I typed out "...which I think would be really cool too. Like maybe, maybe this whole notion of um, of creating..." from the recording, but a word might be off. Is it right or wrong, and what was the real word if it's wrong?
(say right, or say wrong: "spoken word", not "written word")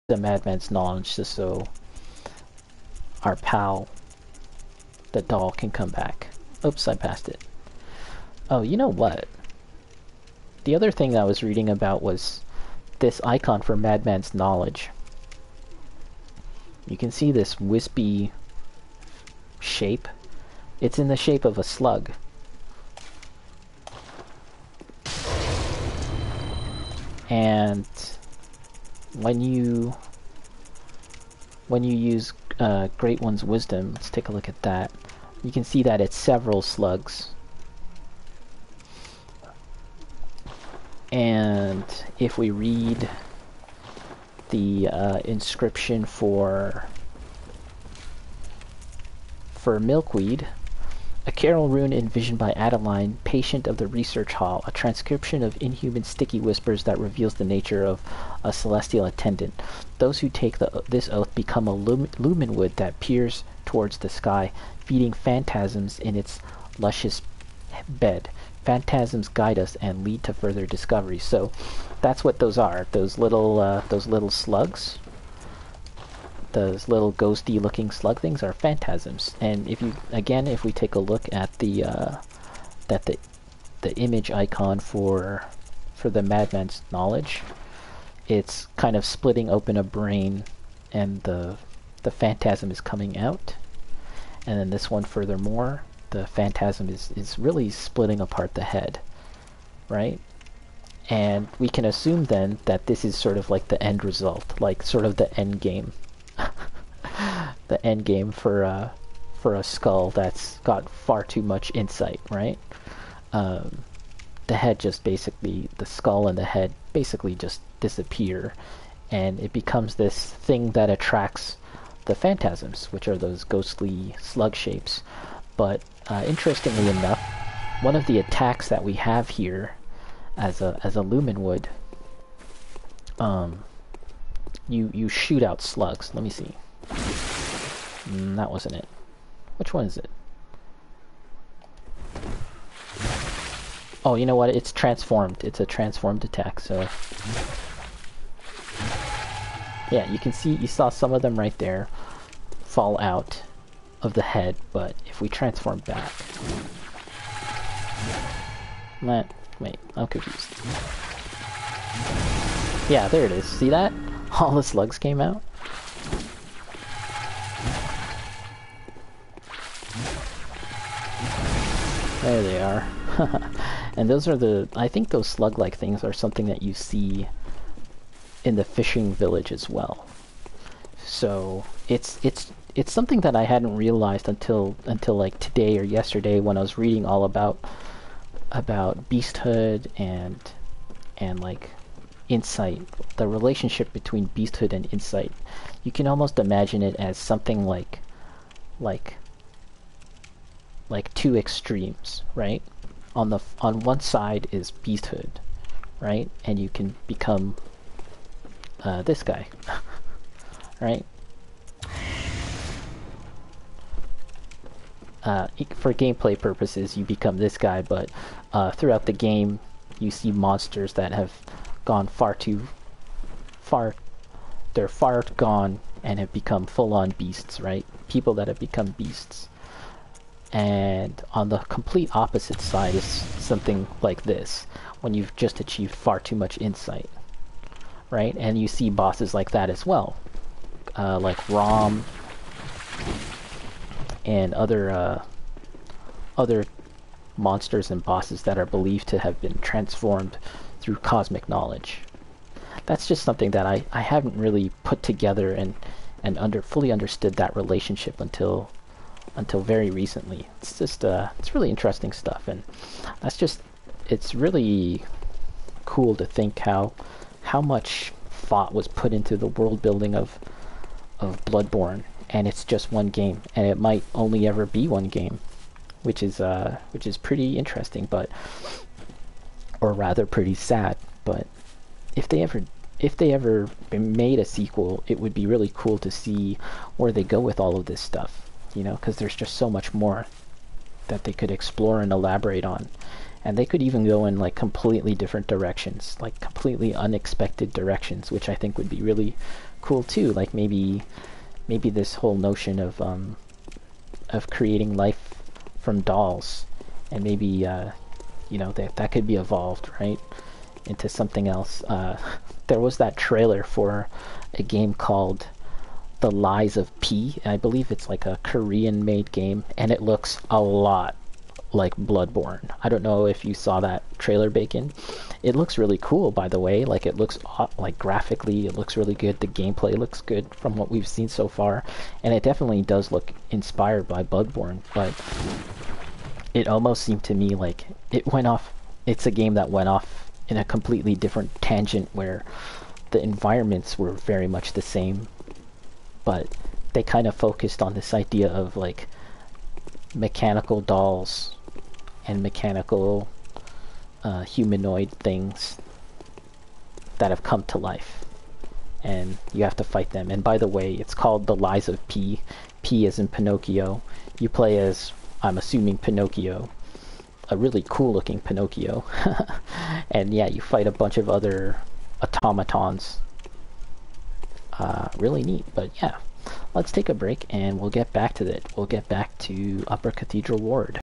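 right.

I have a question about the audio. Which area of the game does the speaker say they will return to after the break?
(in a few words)
Upper Cathedral Ward.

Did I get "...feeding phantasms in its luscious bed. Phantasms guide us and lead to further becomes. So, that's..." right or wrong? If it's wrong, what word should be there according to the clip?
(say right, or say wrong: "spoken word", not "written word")
wrong: "discoveries", not "becomes".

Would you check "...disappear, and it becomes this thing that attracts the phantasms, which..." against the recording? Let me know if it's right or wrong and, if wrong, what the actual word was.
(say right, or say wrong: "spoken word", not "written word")
right.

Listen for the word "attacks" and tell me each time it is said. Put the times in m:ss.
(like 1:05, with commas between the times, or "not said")
2:08, 2:26.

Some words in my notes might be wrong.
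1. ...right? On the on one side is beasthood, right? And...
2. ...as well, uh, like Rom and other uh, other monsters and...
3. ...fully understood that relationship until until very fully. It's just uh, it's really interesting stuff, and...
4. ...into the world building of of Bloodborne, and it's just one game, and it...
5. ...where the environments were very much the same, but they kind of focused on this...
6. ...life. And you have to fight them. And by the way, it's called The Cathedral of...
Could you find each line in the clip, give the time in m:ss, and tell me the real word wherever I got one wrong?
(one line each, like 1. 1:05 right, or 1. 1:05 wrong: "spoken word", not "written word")
1. 3:22 right
2. 3:59 right
3. 4:16 wrong: "recently", not "fully"
4. 4:29 right
5. 5:42 right
6. 5:57 wrong: "Lies", not "Cathedral".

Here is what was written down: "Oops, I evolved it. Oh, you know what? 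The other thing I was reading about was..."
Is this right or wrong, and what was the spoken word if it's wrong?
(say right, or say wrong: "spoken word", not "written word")
wrong: "passed", not "evolved".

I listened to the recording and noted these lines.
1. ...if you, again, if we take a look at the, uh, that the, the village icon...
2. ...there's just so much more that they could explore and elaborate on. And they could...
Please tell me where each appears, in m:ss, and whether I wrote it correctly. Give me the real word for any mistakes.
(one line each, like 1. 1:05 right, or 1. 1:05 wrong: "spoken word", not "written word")
1. 1:19 wrong: "image", not "village"
2. 4:49 right.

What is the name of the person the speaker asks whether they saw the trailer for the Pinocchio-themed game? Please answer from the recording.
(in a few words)
Bacon.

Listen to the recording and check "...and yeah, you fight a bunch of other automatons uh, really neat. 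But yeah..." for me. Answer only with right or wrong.
right.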